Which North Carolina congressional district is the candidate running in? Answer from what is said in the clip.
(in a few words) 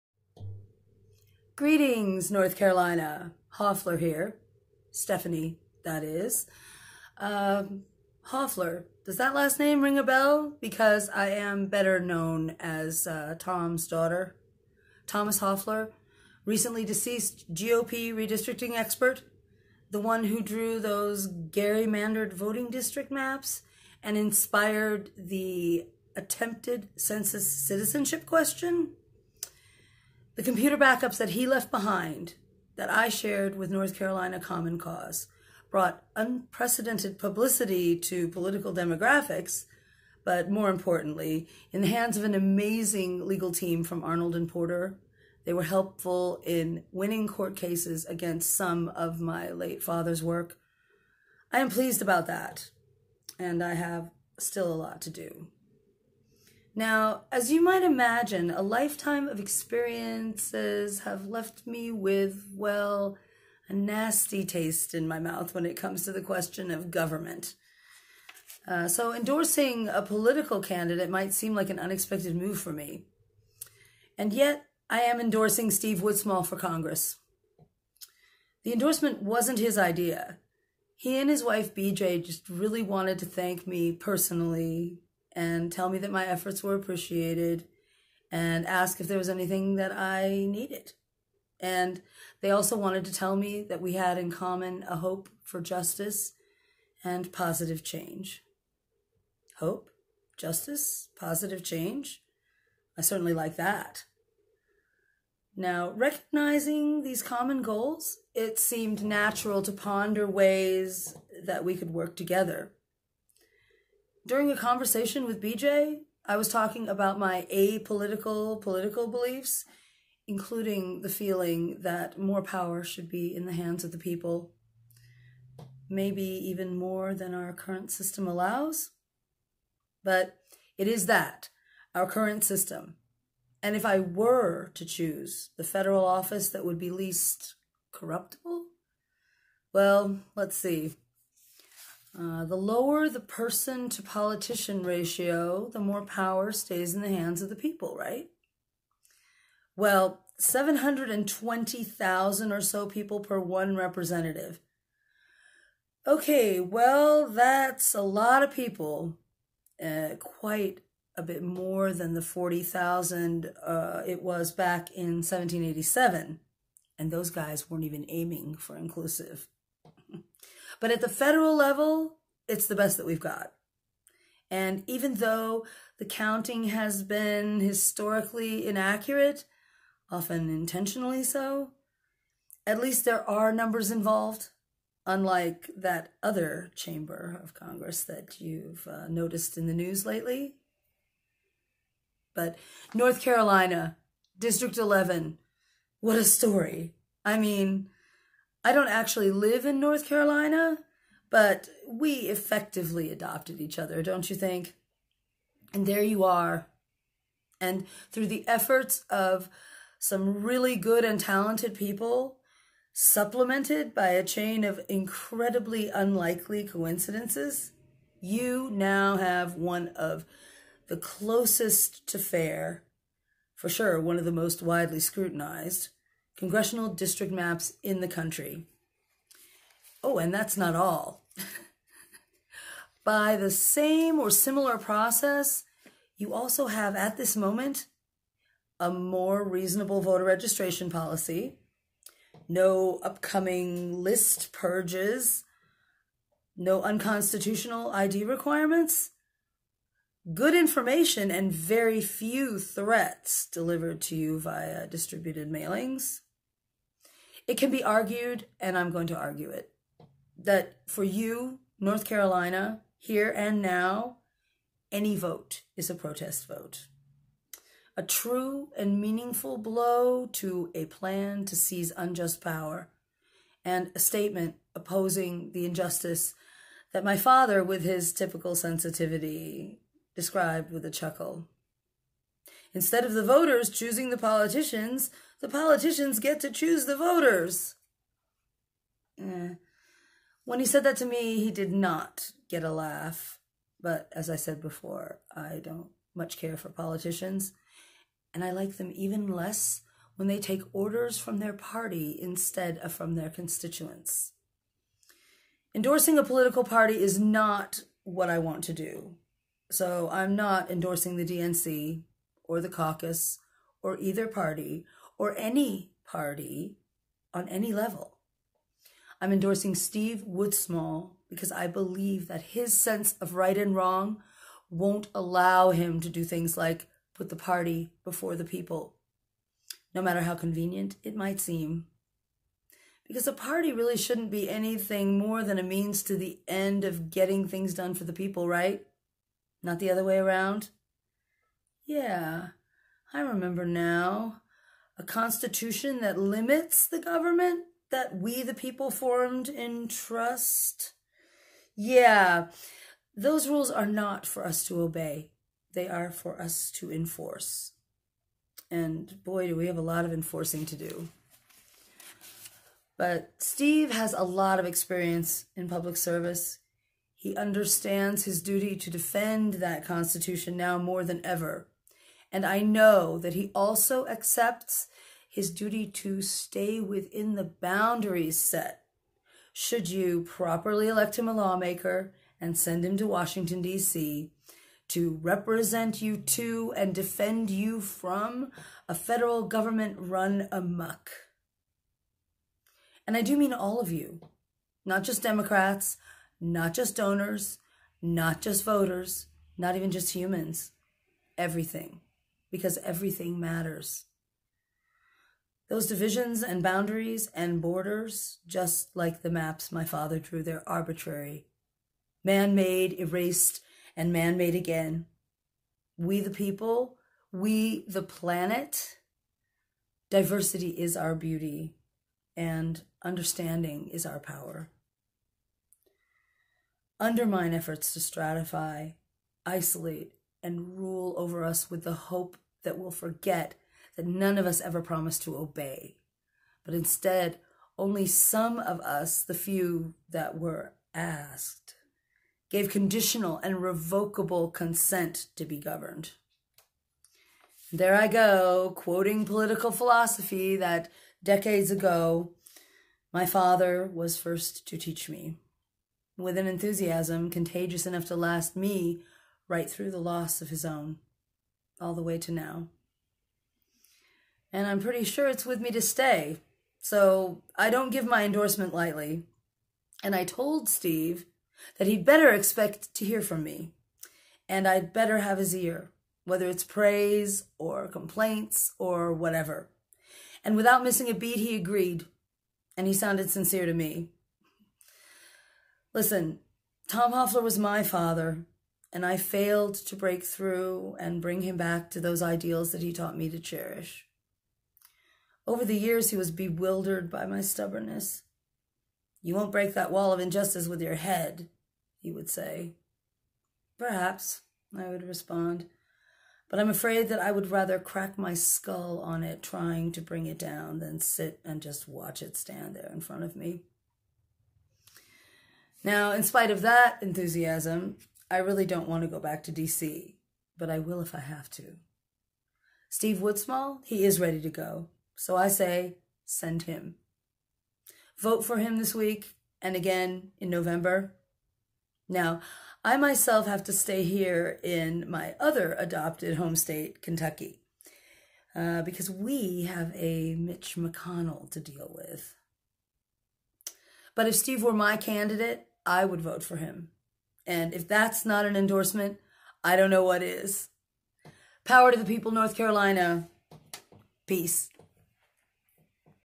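District 11.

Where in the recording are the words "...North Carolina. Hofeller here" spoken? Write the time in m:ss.
0:02.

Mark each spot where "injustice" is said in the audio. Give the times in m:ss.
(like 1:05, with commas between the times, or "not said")
4:35, 8:20.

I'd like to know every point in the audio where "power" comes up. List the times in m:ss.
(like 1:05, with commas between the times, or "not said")
2:02, 2:26, 4:32, 7:04, 9:11.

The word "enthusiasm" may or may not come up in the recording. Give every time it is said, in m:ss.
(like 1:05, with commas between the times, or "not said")
7:36, 8:37.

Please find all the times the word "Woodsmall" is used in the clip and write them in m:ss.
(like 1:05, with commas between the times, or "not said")
1:16, 5:20, 8:43.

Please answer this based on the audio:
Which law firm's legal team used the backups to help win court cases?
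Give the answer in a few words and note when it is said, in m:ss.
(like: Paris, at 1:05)
Arnold and Porter, at 0:44.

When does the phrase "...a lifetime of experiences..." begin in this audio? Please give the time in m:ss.
0:58.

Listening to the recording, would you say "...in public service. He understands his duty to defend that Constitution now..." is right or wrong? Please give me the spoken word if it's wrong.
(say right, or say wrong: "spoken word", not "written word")
right.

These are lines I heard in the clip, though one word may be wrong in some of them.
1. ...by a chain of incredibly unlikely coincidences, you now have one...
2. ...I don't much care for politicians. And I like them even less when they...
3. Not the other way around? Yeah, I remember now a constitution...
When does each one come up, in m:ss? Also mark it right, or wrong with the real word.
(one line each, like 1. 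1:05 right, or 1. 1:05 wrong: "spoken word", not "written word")
1. 3:33 right
2. 4:55 right
3. 5:39 right.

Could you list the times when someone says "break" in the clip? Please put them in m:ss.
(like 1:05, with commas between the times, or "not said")
8:09, 8:19.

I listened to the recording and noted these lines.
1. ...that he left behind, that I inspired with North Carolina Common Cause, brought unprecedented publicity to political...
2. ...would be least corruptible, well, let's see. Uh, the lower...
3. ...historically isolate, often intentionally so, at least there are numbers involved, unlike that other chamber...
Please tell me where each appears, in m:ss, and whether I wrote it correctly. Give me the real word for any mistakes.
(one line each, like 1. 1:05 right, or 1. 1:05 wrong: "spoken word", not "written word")
1. 0:31 wrong: "shared", not "inspired"
2. 2:16 right
3. 2:57 wrong: "inaccurate", not "isolate".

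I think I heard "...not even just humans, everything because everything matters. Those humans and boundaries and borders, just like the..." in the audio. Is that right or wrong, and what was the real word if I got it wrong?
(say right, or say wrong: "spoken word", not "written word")
wrong: "divisions", not "humans".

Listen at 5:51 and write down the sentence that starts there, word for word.
Yeah, those rules are not for us to obey, they are for us to enforce.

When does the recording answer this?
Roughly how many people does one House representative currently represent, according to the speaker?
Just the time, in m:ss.
2:30.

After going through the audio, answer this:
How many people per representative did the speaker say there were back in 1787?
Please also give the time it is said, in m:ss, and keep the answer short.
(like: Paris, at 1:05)
40,000, at 2:42.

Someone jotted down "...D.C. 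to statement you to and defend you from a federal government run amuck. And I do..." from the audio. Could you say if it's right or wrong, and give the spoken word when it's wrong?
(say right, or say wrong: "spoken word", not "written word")
wrong: "represent", not "statement".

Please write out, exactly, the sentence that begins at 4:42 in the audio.
Instead of the voters choosing the politicians, the politicians get to choose the voters.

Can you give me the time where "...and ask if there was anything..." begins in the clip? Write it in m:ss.
1:28.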